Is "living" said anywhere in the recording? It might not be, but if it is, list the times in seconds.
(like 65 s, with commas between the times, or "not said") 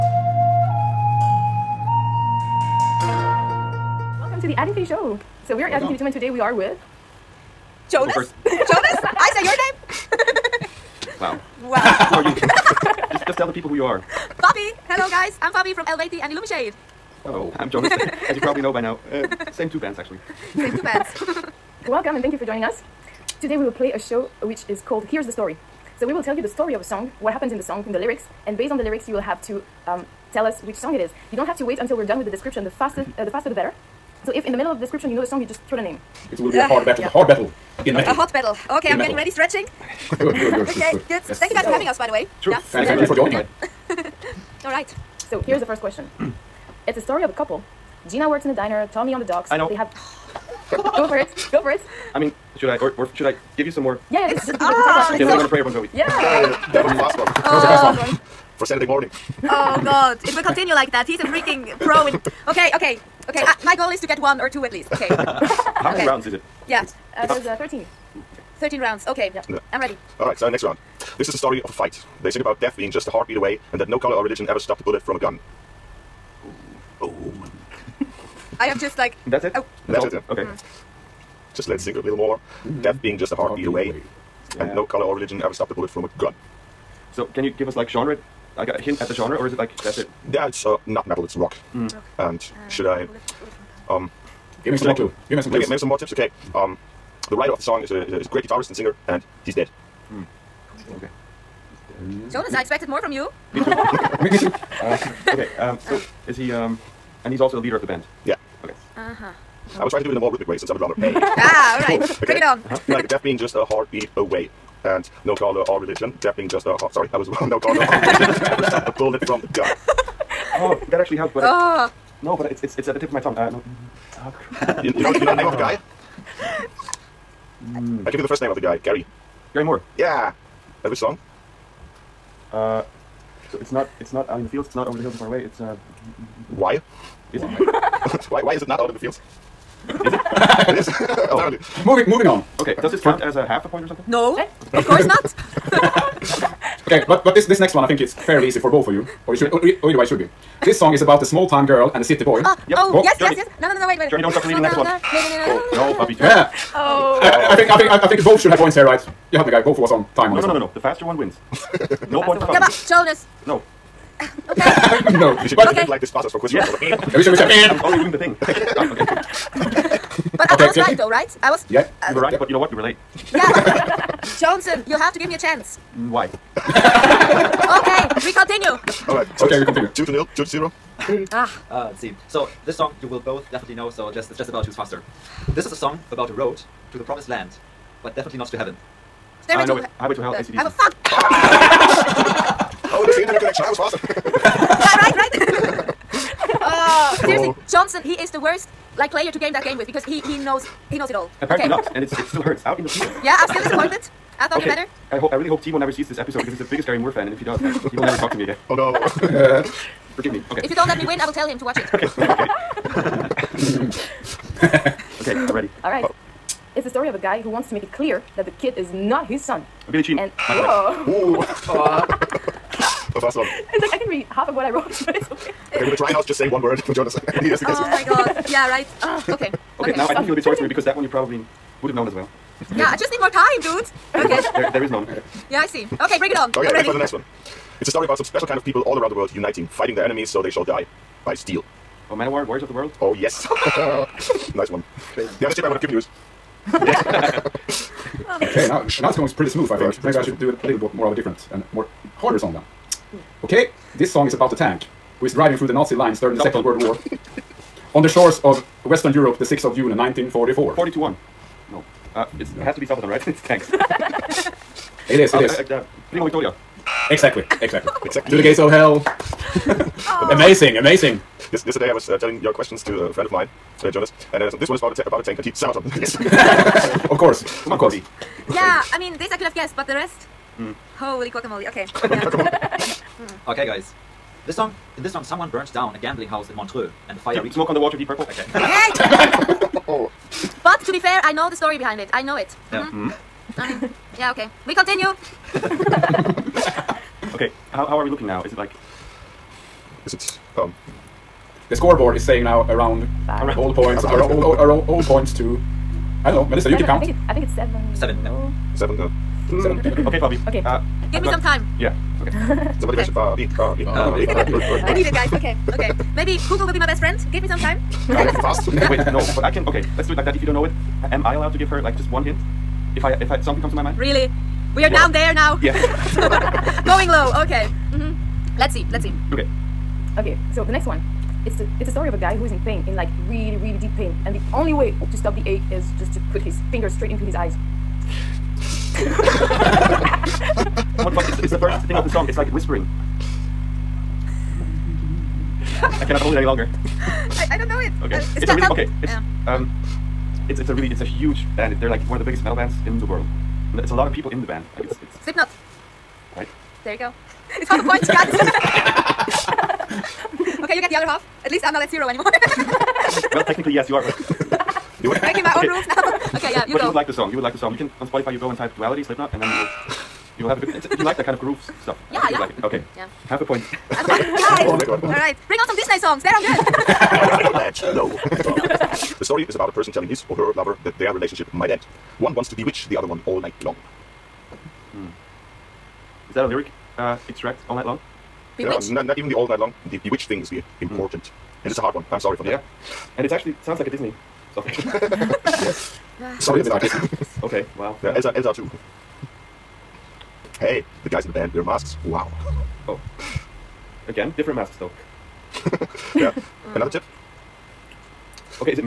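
55 s.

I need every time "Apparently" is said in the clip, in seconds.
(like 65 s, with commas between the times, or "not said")
141 s, 201 s.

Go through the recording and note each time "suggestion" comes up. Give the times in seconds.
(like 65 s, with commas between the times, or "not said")
not said.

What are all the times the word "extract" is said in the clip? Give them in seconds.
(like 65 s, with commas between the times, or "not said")
387 s.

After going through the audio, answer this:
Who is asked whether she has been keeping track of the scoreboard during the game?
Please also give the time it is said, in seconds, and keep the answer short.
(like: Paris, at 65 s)
Melissa, at 306 s.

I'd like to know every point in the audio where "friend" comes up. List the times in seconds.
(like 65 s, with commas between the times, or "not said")
273 s, 316 s.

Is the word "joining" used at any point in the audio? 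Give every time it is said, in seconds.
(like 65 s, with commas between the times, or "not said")
22 s, 43 s.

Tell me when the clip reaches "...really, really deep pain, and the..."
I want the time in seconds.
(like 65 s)
333 s.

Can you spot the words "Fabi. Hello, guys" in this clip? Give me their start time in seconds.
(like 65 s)
14 s.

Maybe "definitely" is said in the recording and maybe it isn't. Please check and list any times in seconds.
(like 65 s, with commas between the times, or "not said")
183 s, 188 s.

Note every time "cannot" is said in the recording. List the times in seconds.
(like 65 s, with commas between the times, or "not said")
346 s.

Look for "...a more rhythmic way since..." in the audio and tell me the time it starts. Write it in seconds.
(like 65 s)
110 s.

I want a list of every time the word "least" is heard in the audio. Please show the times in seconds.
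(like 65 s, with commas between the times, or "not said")
64 s, 361 s.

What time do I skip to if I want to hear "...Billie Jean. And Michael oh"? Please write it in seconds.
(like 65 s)
219 s.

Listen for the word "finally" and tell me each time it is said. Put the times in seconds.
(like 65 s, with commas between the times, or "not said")
not said.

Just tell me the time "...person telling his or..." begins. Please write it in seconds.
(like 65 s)
379 s.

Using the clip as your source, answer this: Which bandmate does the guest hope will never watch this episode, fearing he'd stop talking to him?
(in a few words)
Timo.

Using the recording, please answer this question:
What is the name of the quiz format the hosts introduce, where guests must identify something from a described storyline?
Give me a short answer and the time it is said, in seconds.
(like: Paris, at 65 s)
Here's the Story, at 25 s.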